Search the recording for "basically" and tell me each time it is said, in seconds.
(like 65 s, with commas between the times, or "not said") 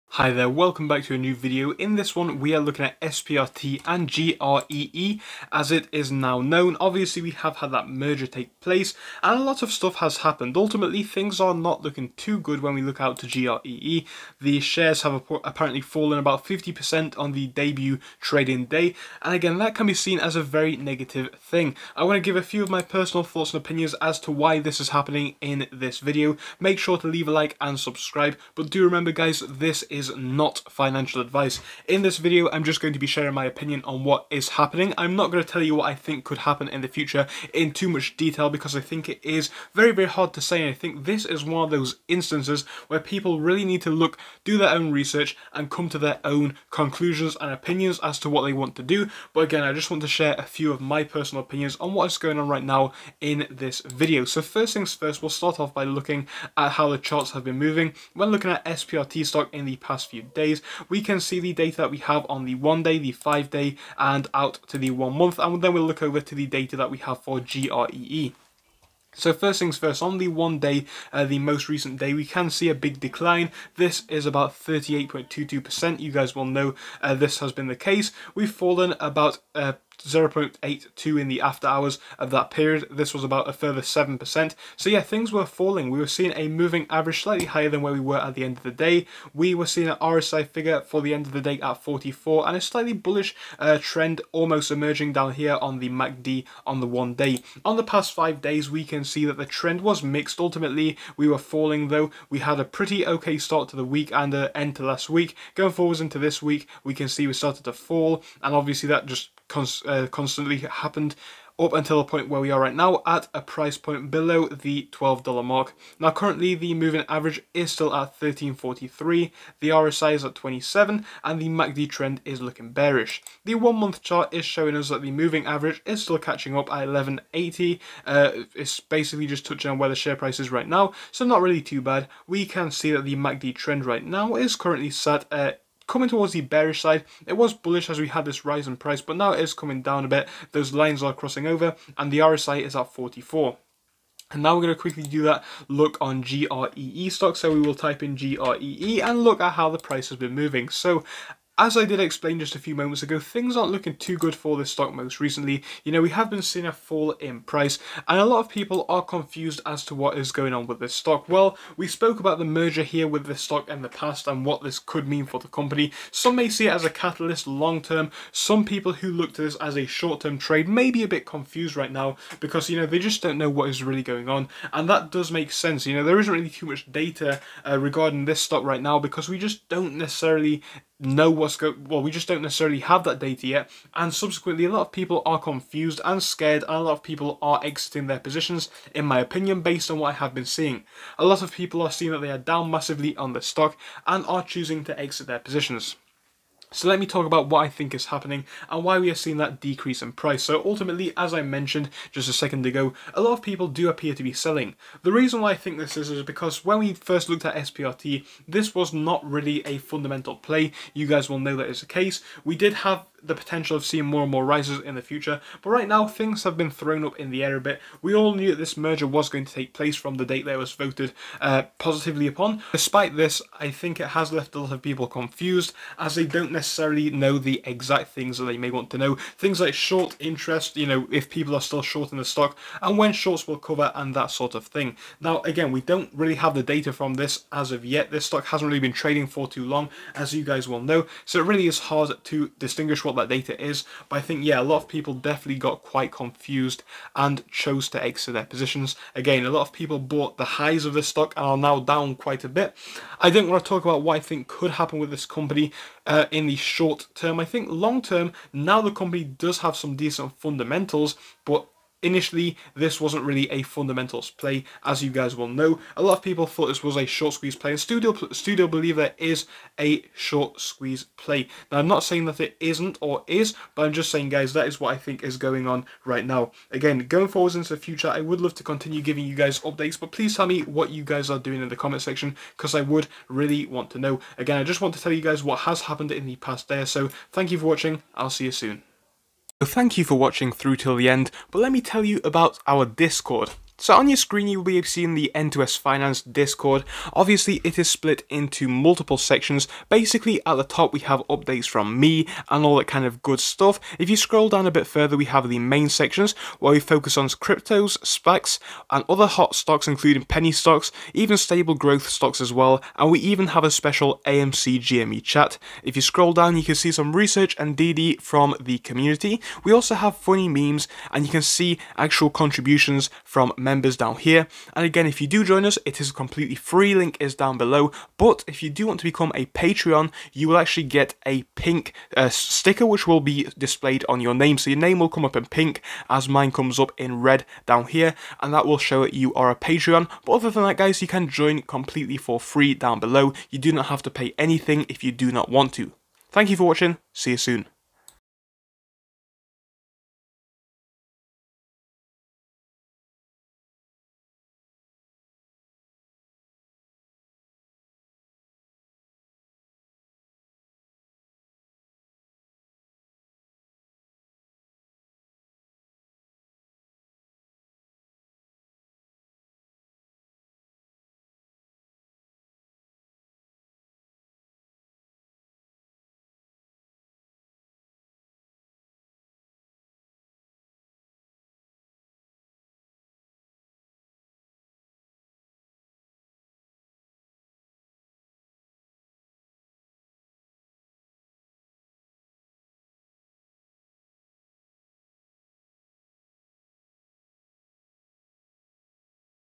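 128 s, 299 s.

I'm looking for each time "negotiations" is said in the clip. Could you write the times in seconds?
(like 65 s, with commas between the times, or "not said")
not said.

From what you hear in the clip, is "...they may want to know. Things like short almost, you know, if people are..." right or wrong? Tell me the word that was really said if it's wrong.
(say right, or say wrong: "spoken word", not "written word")
wrong: "interest", not "almost".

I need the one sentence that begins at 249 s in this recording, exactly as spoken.
Again, a lot of people bought the highs of the stock and are now down quite a bit.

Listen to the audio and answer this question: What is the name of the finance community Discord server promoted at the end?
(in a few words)
N2S Finance.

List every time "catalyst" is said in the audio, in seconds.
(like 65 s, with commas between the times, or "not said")
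166 s.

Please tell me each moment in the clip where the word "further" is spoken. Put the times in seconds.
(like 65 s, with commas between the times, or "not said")
83 s, 304 s.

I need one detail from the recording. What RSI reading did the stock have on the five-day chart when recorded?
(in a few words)
27.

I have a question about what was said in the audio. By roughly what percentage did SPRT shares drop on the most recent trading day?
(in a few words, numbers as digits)
38.22%.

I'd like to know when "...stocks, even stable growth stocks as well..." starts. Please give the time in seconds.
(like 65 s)
310 s.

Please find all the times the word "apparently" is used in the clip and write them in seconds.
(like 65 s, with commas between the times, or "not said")
15 s.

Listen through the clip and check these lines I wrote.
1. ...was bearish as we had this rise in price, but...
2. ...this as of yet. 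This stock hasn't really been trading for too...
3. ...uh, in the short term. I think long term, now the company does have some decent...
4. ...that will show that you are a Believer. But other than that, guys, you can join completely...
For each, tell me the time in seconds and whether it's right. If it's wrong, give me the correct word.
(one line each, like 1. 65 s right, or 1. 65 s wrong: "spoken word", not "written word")
1. 137 s wrong: "bullish", not "bearish"
2. 237 s right
3. 256 s right
4. 338 s wrong: "Patreon", not "Believer".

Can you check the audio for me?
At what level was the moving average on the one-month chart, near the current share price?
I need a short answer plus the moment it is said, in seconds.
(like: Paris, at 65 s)
11.80, at 126 s.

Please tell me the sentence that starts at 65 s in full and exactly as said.
And then we'll look over to the data that we have for GREE.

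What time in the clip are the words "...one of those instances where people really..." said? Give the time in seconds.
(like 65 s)
41 s.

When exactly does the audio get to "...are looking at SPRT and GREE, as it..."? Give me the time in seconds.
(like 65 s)
2 s.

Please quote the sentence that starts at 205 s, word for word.
The reason why I think this is is because when we first looked at SPRT, this was not really a fundamental play.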